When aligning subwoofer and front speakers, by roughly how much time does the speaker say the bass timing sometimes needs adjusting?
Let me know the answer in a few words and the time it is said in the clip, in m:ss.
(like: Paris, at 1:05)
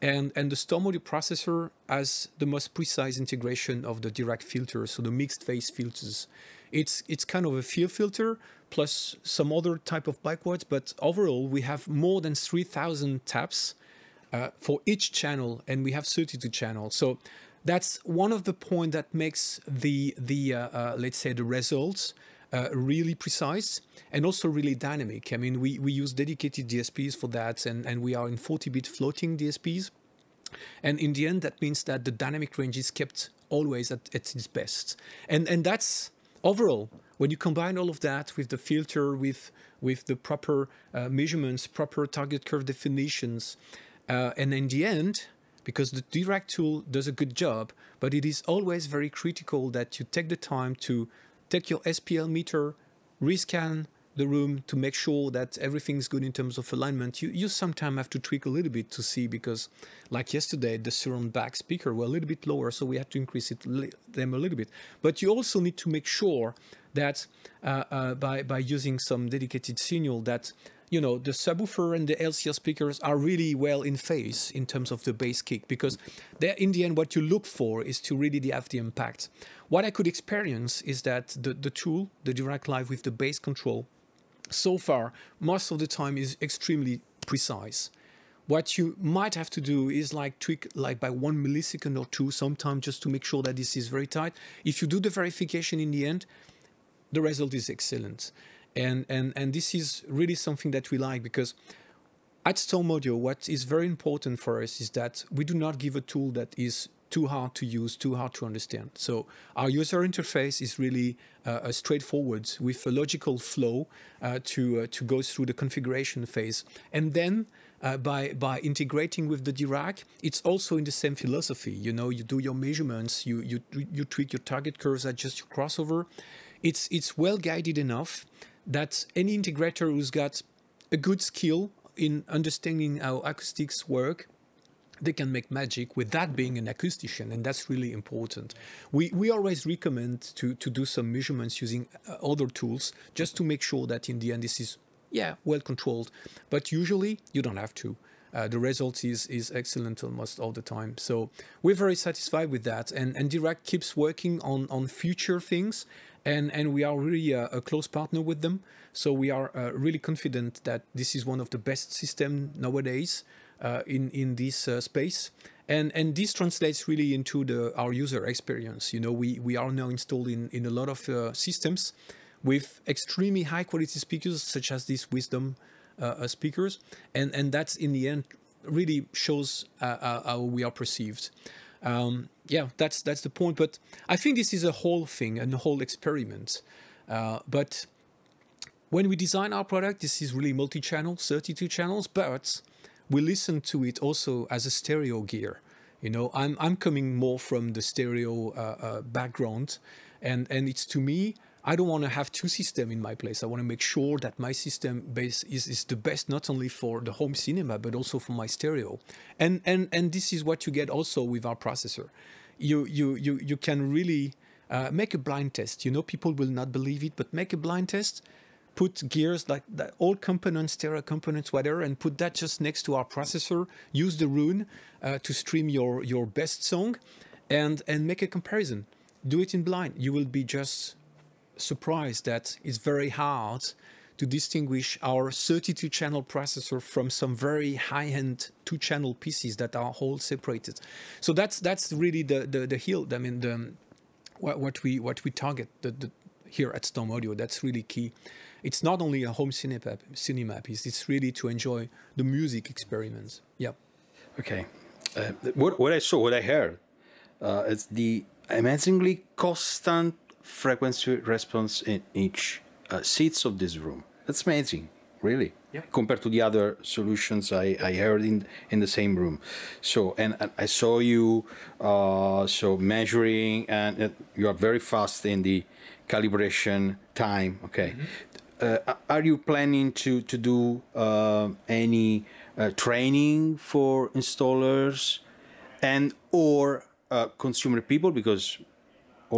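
1 millisecond, at 1:31.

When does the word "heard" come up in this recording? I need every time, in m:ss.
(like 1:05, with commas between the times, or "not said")
4:16, 4:27.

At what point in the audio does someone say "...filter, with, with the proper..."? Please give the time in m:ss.
0:38.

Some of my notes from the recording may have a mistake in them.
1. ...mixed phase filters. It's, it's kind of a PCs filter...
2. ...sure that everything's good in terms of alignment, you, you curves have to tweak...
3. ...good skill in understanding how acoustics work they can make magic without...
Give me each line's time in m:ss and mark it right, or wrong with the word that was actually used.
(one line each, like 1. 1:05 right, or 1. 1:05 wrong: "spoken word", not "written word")
1. 0:05 wrong: "FIR", not "PCs"
2. 0:54 wrong: "sometimes", not "curves"
3. 2:10 right.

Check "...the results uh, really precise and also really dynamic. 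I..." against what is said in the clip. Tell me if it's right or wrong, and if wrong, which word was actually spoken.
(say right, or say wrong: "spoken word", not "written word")
right.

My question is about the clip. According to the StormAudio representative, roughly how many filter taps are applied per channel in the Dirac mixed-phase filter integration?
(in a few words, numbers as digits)
3,000.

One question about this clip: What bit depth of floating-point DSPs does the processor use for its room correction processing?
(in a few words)
40-bit.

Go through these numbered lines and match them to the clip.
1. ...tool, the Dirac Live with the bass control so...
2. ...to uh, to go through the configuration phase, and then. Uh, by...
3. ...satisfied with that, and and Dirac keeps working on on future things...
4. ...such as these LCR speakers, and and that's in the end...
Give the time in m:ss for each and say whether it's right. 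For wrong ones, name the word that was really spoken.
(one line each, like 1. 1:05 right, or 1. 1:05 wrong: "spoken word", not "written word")
1. 1:21 right
2. 1:54 right
3. 2:31 right
4. 2:54 wrong: "Wisdom", not "LCR".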